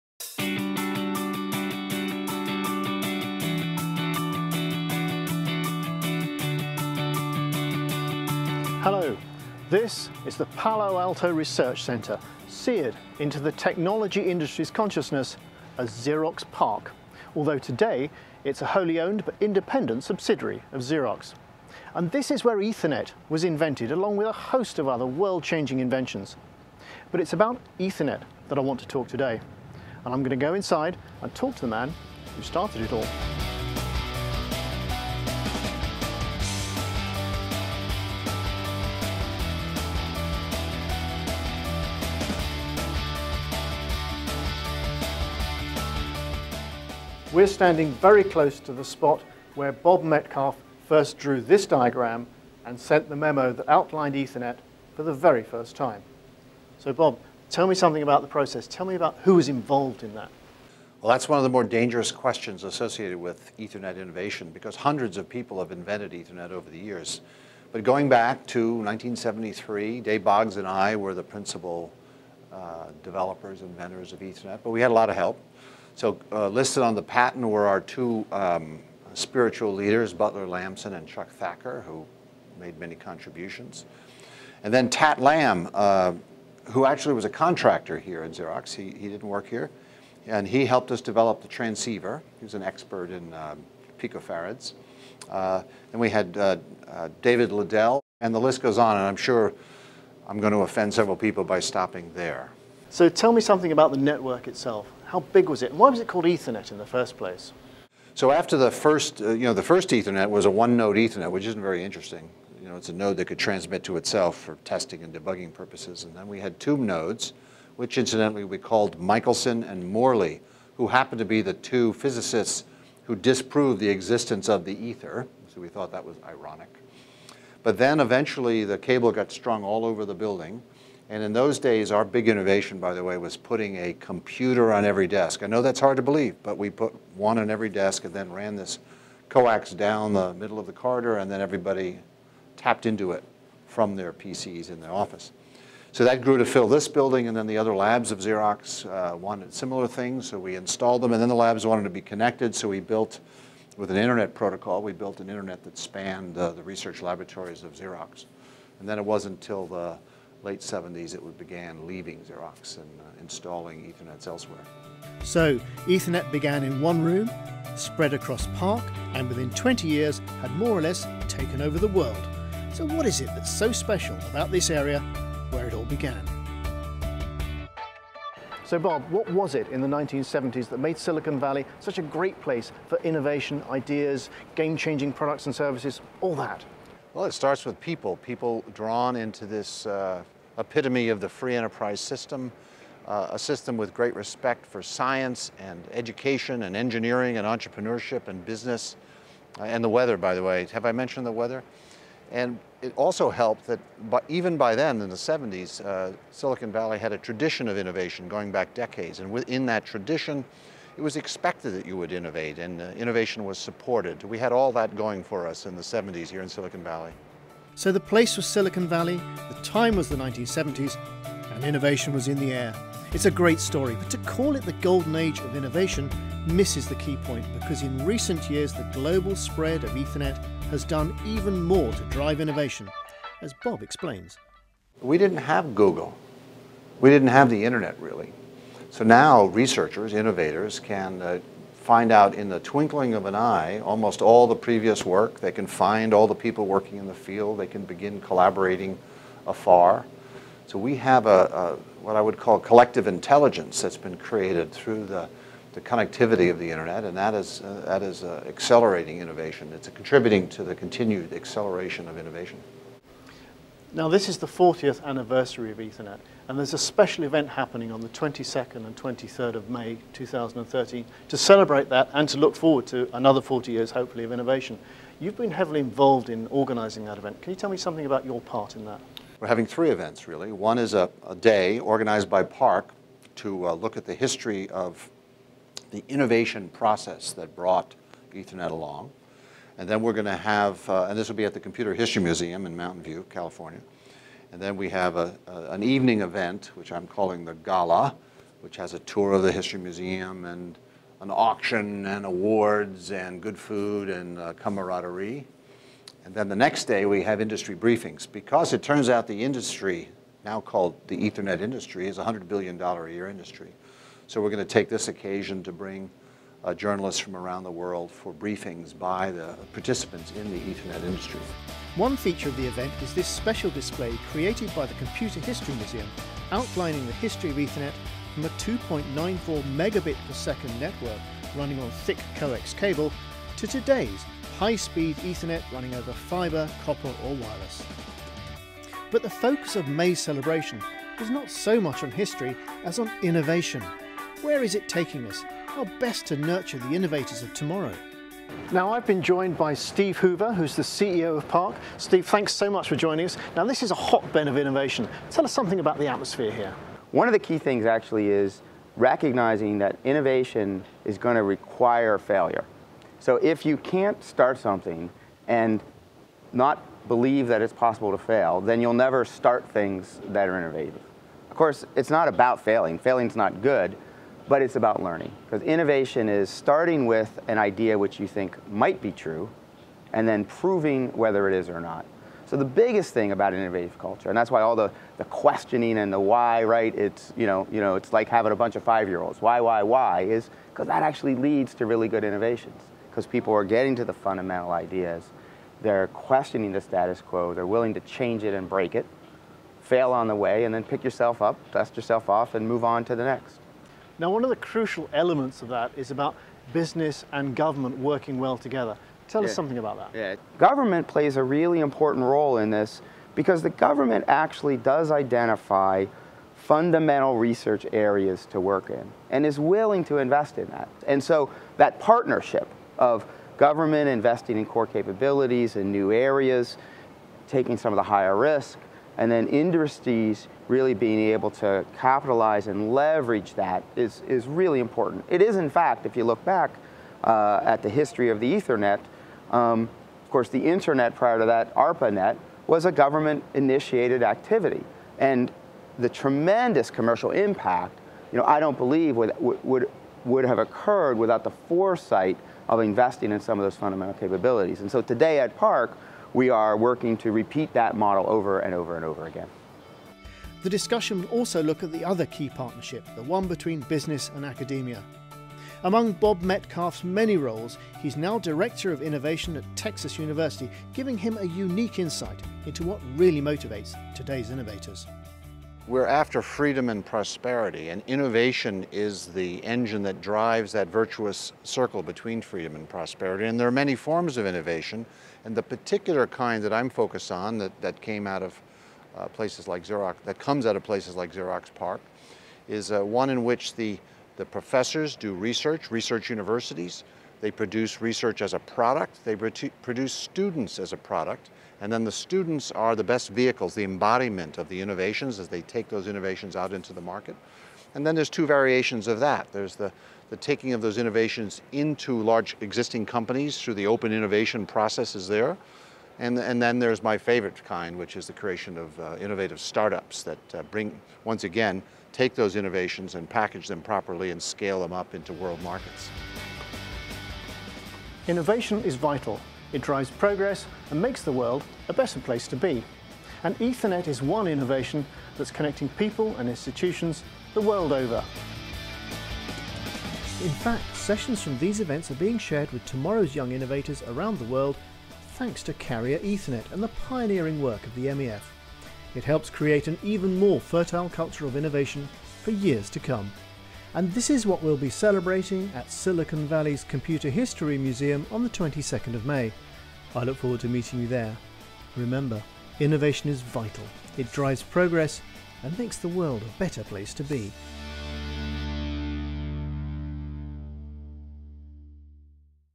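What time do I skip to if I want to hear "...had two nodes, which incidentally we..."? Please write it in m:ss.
1:56.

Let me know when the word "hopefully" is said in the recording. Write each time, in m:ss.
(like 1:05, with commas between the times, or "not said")
4:33.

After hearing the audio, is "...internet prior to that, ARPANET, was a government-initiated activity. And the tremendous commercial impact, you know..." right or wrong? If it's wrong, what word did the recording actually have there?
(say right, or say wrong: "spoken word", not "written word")
right.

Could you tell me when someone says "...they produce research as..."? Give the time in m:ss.
8:17.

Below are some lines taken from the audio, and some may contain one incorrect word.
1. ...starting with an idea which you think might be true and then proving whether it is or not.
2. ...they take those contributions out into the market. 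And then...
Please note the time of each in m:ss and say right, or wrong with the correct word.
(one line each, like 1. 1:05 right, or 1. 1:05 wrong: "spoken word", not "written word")
1. 6:16 right
2. 8:25 wrong: "innovations", not "contributions".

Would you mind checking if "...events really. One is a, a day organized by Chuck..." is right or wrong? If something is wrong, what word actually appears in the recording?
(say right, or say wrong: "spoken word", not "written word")
wrong: "PARC", not "Chuck".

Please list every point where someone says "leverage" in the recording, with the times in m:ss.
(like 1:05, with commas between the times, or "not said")
7:12.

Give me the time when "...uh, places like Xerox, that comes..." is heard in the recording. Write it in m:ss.
8:09.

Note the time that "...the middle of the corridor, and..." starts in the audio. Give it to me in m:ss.
2:20.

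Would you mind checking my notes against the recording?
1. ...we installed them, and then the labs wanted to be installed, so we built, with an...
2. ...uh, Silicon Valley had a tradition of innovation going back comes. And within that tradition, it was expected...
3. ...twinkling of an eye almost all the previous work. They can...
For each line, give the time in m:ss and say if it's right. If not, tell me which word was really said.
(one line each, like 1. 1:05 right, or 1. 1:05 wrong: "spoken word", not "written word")
1. 2:30 wrong: "connected", not "installed"
2. 3:25 wrong: "decades", not "comes"
3. 4:02 right.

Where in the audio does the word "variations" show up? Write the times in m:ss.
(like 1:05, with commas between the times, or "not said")
8:28.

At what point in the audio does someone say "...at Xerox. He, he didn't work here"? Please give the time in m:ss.
1:28.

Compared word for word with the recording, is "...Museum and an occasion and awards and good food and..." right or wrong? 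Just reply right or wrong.
wrong.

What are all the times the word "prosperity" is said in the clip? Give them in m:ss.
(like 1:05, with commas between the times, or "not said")
7:57, 8:02.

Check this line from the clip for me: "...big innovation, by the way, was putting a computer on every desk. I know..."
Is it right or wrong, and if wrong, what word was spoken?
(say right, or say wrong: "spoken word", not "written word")
right.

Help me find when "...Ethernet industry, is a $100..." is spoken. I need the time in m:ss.
5:11.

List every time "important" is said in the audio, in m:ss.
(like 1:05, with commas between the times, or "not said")
6:51, 7:14.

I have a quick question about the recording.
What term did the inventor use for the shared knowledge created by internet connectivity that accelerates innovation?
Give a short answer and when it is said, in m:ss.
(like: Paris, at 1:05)
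collective intelligence, at 4:12.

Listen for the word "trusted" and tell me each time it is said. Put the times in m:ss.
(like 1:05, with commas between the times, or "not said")
not said.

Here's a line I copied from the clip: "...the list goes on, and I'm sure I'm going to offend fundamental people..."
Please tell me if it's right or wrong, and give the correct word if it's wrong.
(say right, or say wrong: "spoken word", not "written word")
wrong: "several", not "fundamental".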